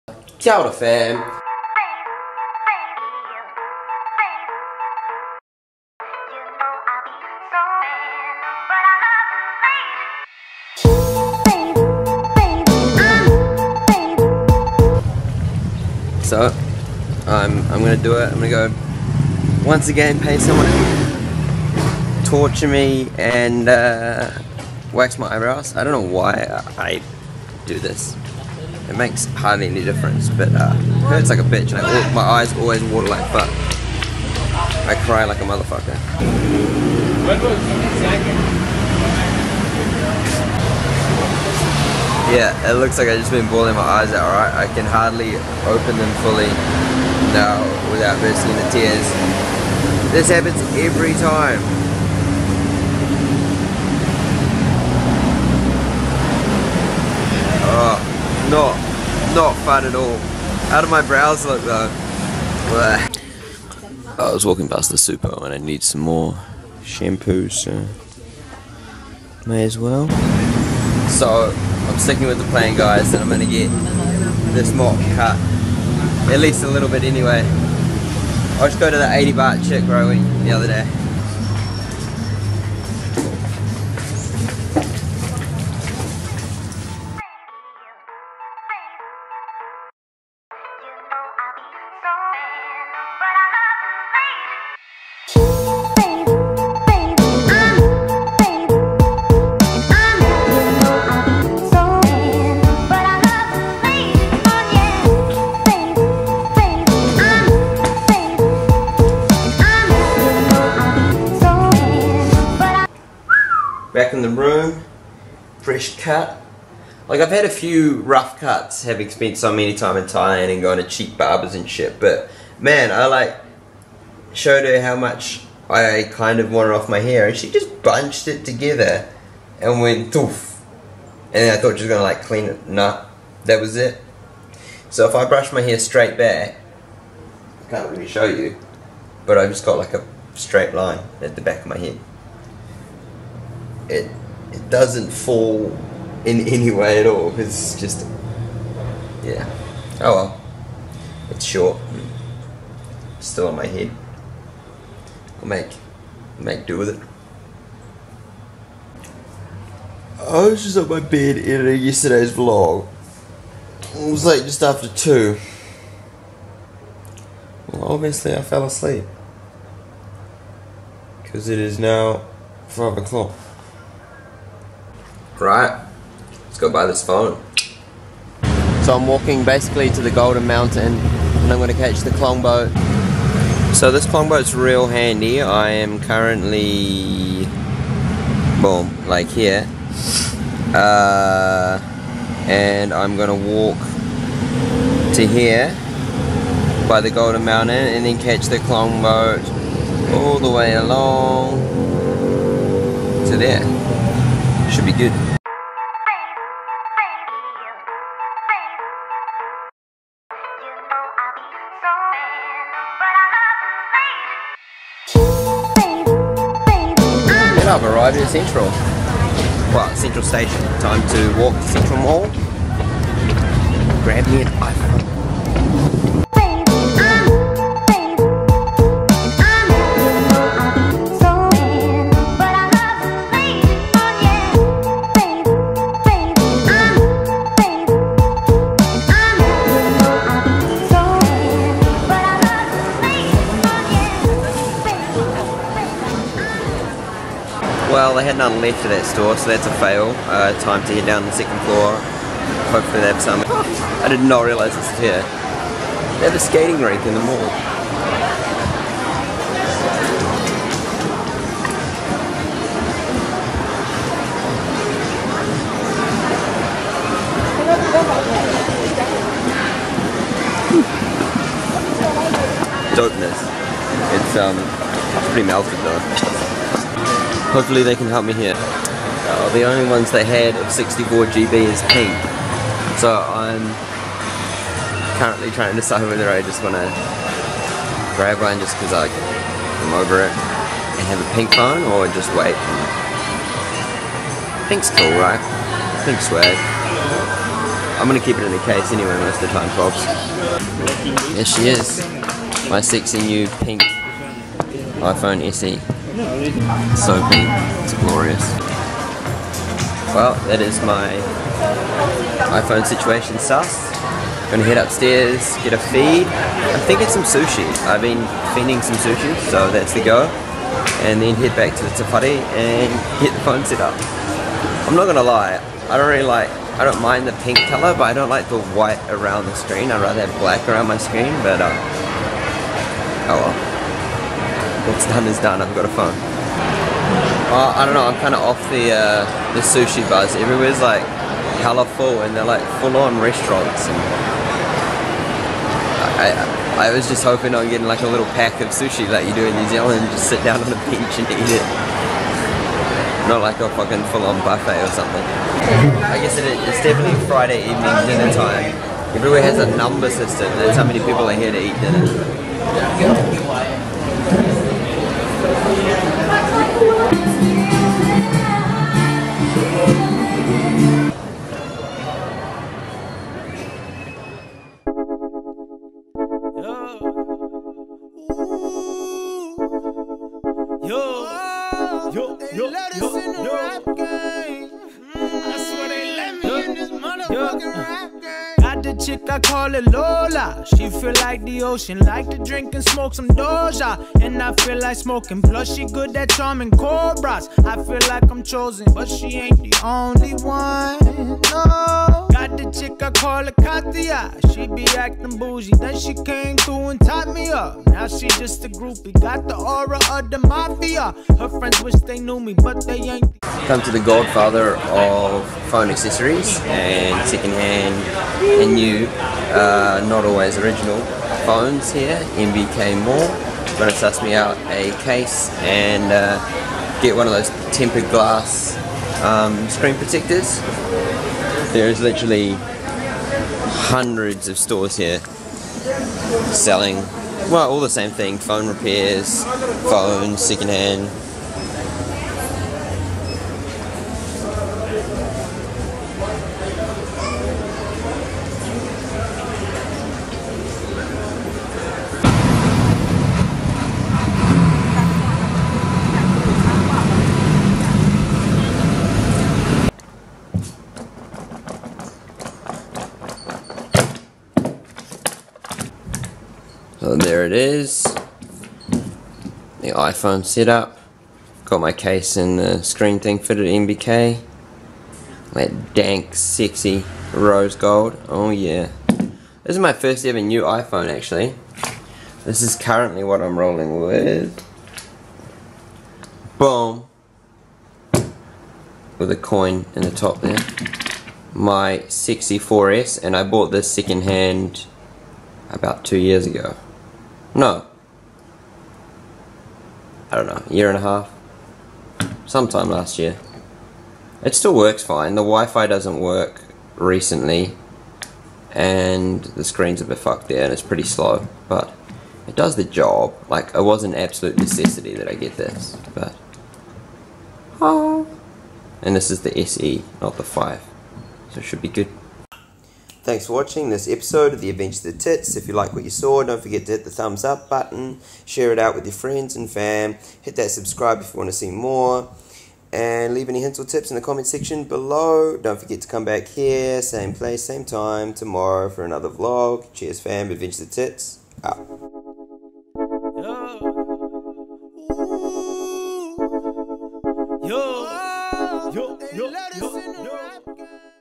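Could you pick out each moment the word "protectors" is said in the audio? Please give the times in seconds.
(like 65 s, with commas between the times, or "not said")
429 s.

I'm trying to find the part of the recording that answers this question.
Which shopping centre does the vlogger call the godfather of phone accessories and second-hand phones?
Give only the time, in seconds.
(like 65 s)
422 s.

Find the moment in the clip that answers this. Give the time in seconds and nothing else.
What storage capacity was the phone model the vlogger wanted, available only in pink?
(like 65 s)
280 s.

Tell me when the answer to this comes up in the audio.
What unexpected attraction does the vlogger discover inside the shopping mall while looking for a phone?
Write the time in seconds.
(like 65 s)
256 s.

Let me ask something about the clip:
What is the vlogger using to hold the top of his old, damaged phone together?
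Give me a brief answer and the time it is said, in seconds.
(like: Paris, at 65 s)
a coin, at 489 s.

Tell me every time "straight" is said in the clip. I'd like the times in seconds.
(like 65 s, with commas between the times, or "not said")
135 s, 140 s.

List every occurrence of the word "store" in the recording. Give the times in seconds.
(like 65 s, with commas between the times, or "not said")
249 s, 434 s.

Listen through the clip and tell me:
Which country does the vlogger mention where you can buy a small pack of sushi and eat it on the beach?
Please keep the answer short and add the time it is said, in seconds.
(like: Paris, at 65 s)
New Zealand, at 349 s.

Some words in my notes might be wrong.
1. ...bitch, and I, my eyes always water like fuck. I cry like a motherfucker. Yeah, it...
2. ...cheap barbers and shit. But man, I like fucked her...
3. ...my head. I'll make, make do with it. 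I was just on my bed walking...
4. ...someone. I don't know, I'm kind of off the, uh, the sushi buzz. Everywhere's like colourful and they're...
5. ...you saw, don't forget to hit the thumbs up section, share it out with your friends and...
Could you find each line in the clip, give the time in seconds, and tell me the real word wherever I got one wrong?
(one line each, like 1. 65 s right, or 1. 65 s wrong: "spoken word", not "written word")
1. 31 s right
2. 120 s wrong: "showed", not "fucked"
3. 153 s wrong: "editing", not "walking"
4. 335 s wrong: "phone", not "someone"
5. 526 s wrong: "button", not "section".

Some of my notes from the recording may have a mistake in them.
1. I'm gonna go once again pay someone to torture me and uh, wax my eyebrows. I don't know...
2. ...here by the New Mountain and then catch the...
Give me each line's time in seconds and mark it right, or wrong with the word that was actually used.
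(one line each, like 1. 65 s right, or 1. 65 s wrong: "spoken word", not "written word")
1. 18 s right
2. 195 s wrong: "Golden", not "New".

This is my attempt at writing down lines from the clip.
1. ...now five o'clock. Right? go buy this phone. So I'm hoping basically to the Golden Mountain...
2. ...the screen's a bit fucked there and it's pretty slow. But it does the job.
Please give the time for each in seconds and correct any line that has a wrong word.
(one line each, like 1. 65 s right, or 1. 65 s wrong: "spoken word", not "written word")
1. 171 s wrong: "walking", not "hoping"
2. 509 s right.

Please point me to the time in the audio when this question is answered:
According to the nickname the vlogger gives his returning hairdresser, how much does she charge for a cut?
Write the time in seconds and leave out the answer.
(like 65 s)
79 s.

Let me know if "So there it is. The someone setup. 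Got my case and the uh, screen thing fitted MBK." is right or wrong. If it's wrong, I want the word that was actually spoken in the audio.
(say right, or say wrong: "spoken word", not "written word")
wrong: "iPhone", not "someone".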